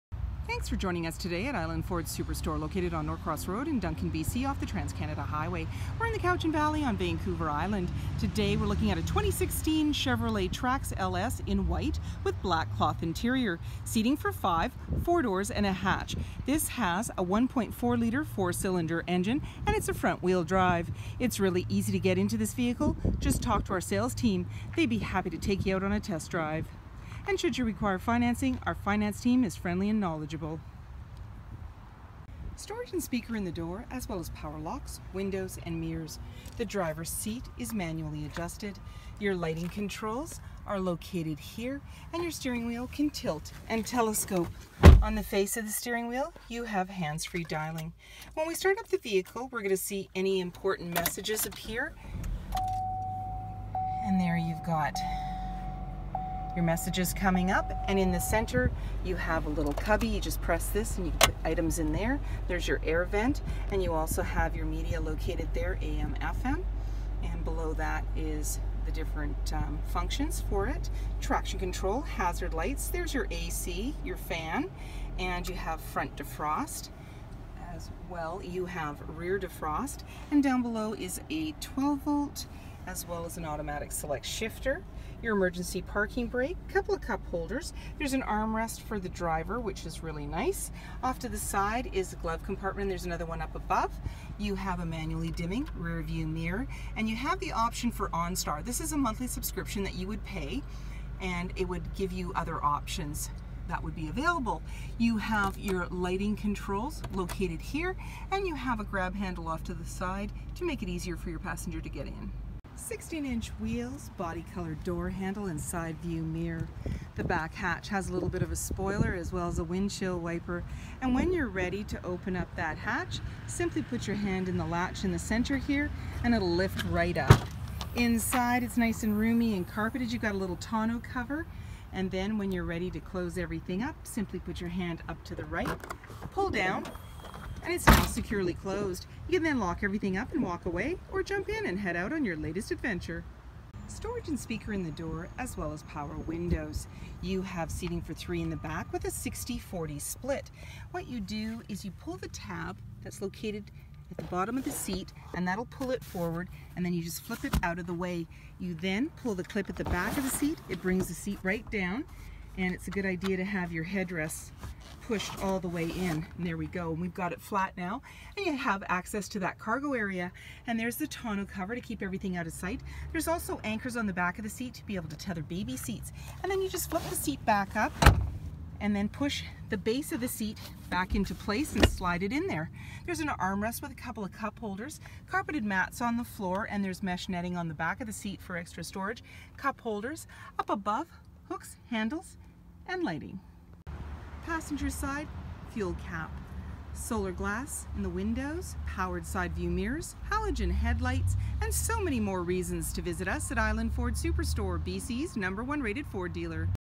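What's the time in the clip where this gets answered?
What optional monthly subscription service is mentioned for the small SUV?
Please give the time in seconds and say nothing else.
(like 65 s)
98 s.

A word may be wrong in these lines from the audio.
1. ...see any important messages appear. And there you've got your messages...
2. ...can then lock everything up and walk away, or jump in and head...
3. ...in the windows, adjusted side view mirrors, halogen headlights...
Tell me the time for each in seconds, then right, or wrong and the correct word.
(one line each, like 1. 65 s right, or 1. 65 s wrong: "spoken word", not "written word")
1. 49 s right
2. 139 s right
3. 197 s wrong: "powered", not "adjusted".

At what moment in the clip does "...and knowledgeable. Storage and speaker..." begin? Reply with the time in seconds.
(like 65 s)
29 s.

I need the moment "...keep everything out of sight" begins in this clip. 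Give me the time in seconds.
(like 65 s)
171 s.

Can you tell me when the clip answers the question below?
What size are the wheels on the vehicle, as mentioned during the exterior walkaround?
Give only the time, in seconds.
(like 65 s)
112 s.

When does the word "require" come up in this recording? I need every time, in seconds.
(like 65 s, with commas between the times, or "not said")
27 s.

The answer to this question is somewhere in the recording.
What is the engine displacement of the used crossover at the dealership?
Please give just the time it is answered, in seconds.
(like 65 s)
17 s.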